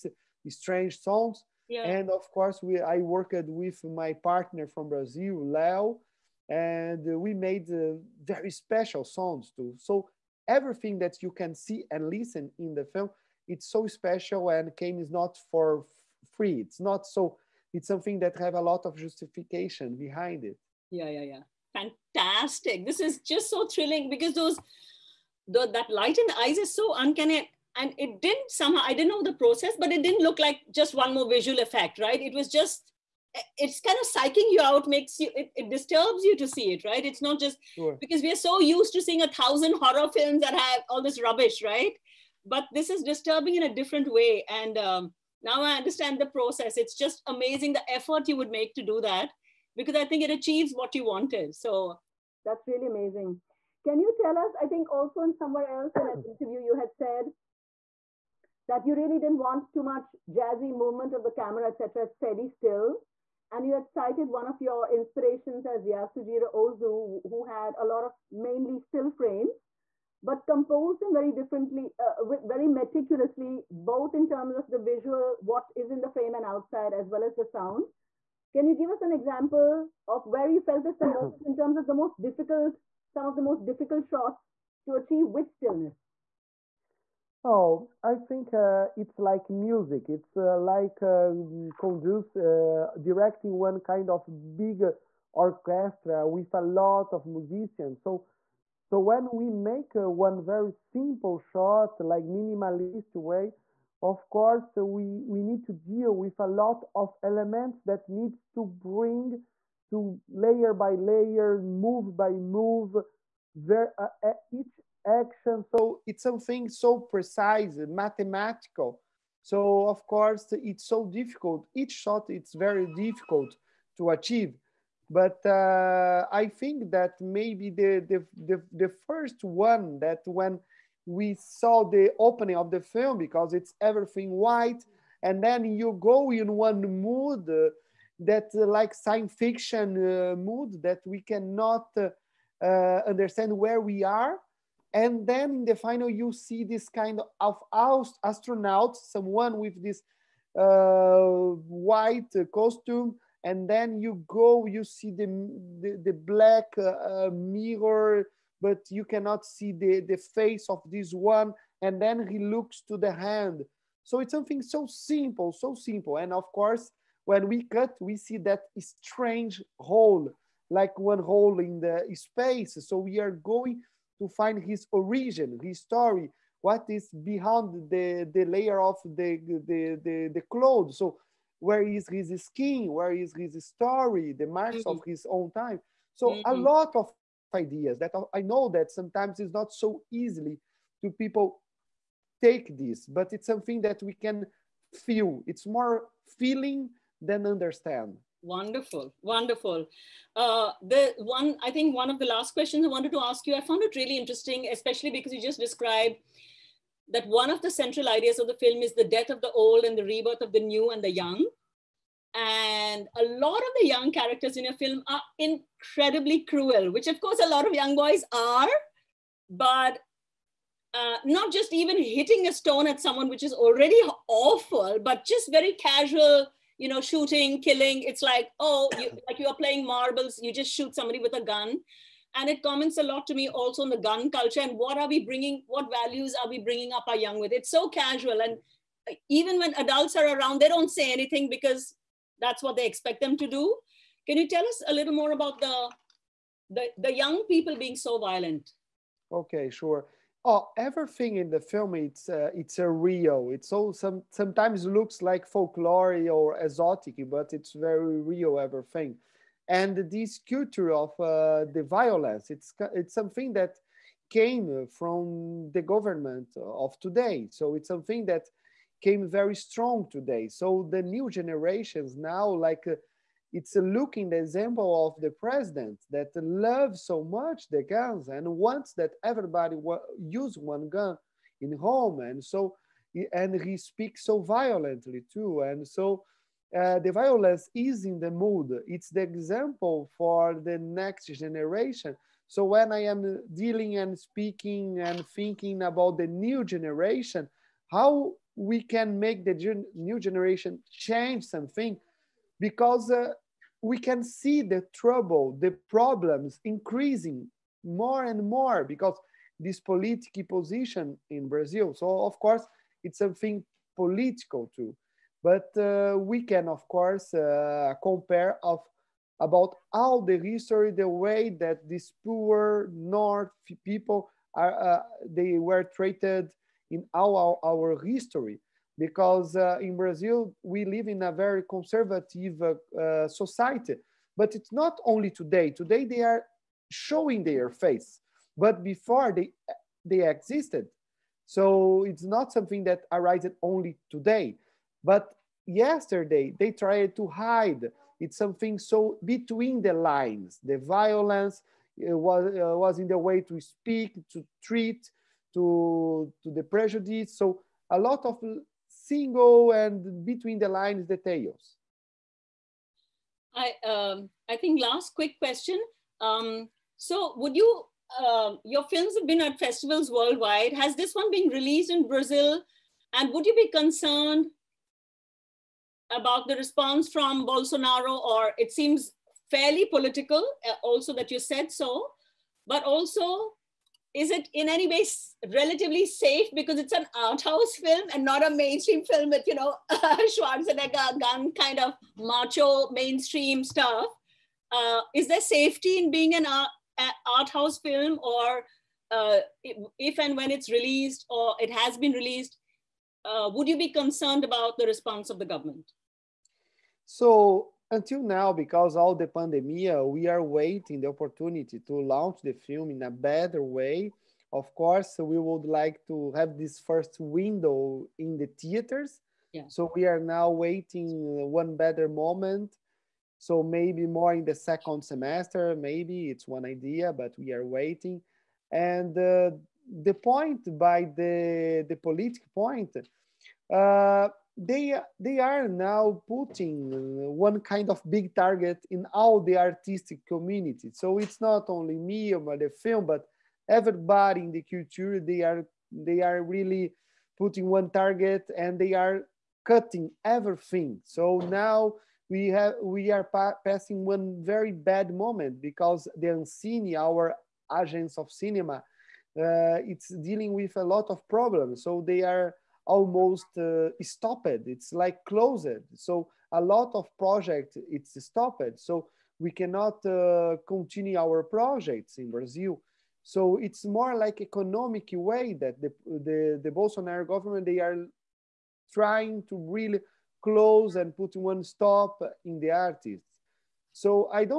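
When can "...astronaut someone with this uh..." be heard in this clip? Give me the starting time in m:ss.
2:28.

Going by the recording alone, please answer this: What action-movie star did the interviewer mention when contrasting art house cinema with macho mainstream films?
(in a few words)
Schwarzenegger.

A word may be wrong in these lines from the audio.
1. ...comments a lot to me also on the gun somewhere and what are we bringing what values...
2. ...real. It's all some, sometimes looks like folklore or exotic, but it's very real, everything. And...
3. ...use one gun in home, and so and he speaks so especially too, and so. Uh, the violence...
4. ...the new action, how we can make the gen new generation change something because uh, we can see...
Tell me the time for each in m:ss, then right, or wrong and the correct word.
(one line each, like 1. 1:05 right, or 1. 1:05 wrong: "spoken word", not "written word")
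1. 3:52 wrong: "culture", not "somewhere"
2. 4:12 right
3. 4:40 wrong: "violently", not "especially"
4. 4:56 wrong: "generation", not "action".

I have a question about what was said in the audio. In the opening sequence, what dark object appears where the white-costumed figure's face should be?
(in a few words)
black mirror.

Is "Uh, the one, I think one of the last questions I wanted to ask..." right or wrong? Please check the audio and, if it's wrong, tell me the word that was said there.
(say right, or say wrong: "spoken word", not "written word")
right.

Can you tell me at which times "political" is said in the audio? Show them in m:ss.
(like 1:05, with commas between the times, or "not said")
5:09, 5:13, 6:19, 7:11.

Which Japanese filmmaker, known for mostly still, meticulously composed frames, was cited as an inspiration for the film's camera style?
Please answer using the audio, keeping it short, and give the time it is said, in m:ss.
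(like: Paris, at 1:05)
Yasujiro Ozu, at 1:05.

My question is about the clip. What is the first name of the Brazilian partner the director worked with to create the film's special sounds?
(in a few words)
Leo.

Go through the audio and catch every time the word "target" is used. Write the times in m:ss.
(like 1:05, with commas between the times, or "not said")
7:18, 7:27.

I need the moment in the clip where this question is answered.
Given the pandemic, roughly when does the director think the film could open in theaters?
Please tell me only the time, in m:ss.
7:04.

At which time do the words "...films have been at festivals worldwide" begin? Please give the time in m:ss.
6:08.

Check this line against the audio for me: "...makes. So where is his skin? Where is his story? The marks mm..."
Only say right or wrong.
wrong.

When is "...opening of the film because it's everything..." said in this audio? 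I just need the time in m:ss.
2:12.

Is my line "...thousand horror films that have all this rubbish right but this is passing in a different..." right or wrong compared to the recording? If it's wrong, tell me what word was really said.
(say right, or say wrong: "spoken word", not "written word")
wrong: "disturbing", not "passing".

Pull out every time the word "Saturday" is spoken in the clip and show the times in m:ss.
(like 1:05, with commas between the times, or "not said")
not said.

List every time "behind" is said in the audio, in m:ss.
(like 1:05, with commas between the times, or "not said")
0:19, 2:57.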